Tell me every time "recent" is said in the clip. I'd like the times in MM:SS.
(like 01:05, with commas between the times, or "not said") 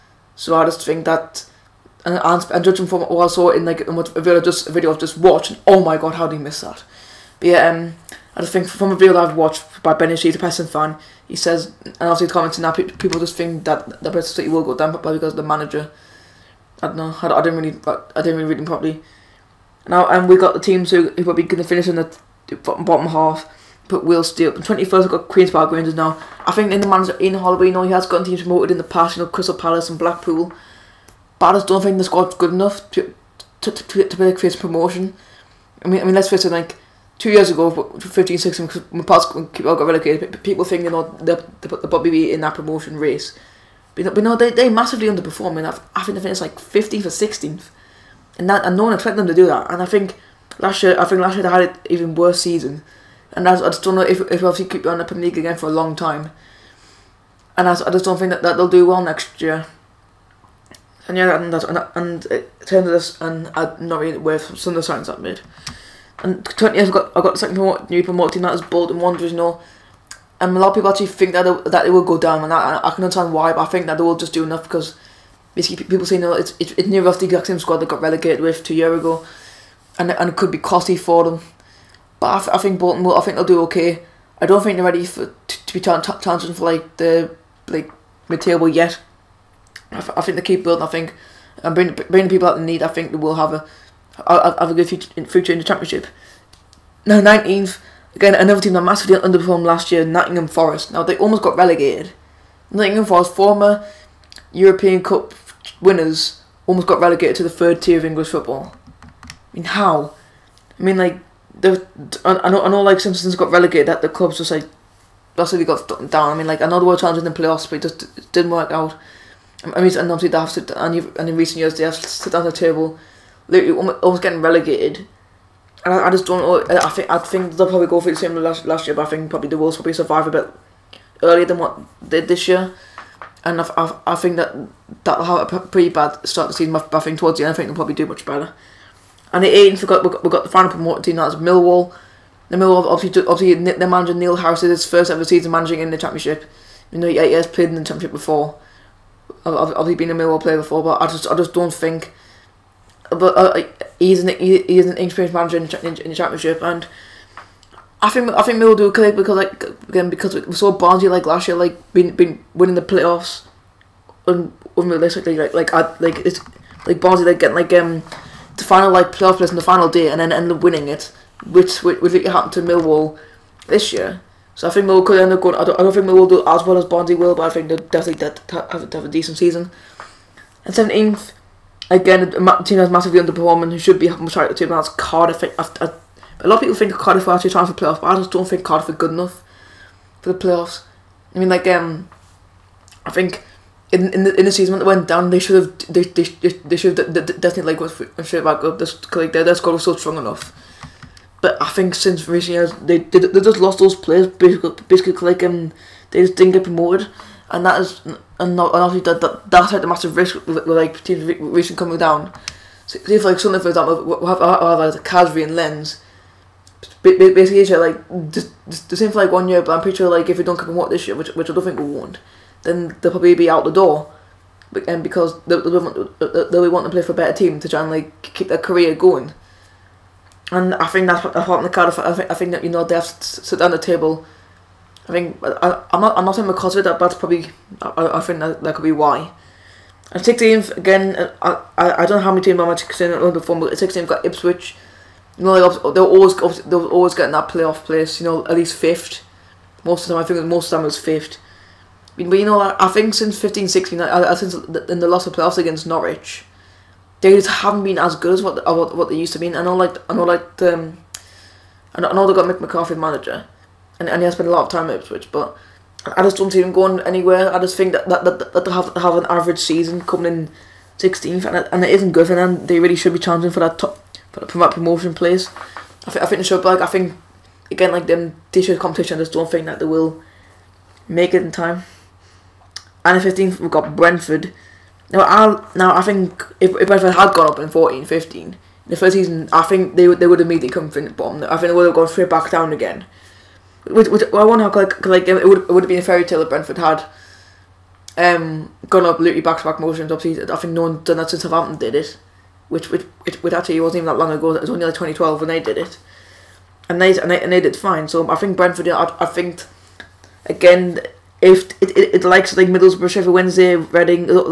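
02:01, 03:22, 03:31.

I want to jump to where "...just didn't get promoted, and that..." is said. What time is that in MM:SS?
03:26.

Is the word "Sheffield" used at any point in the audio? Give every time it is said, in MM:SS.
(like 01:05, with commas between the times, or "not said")
05:13.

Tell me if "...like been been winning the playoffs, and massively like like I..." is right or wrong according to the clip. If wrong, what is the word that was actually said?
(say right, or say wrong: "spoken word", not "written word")
wrong: "unrealistically", not "massively".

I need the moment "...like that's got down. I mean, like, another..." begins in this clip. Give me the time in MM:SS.
01:54.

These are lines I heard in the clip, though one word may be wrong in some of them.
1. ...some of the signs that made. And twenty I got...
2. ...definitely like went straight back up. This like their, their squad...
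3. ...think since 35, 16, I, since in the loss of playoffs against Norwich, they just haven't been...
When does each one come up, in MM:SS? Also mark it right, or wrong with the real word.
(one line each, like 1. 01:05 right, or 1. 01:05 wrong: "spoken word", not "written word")
1. 01:04 right
2. 03:17 right
3. 04:12 wrong: "15", not "35".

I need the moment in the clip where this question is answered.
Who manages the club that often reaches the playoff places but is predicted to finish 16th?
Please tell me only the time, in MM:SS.
04:22.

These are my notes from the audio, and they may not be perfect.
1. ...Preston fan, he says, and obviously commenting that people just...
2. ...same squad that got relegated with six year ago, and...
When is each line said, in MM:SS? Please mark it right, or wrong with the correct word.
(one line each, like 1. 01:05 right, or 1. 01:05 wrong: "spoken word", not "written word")
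1. 00:10 right
2. 01:17 wrong: "two", not "six".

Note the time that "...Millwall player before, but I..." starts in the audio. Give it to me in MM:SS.
02:30.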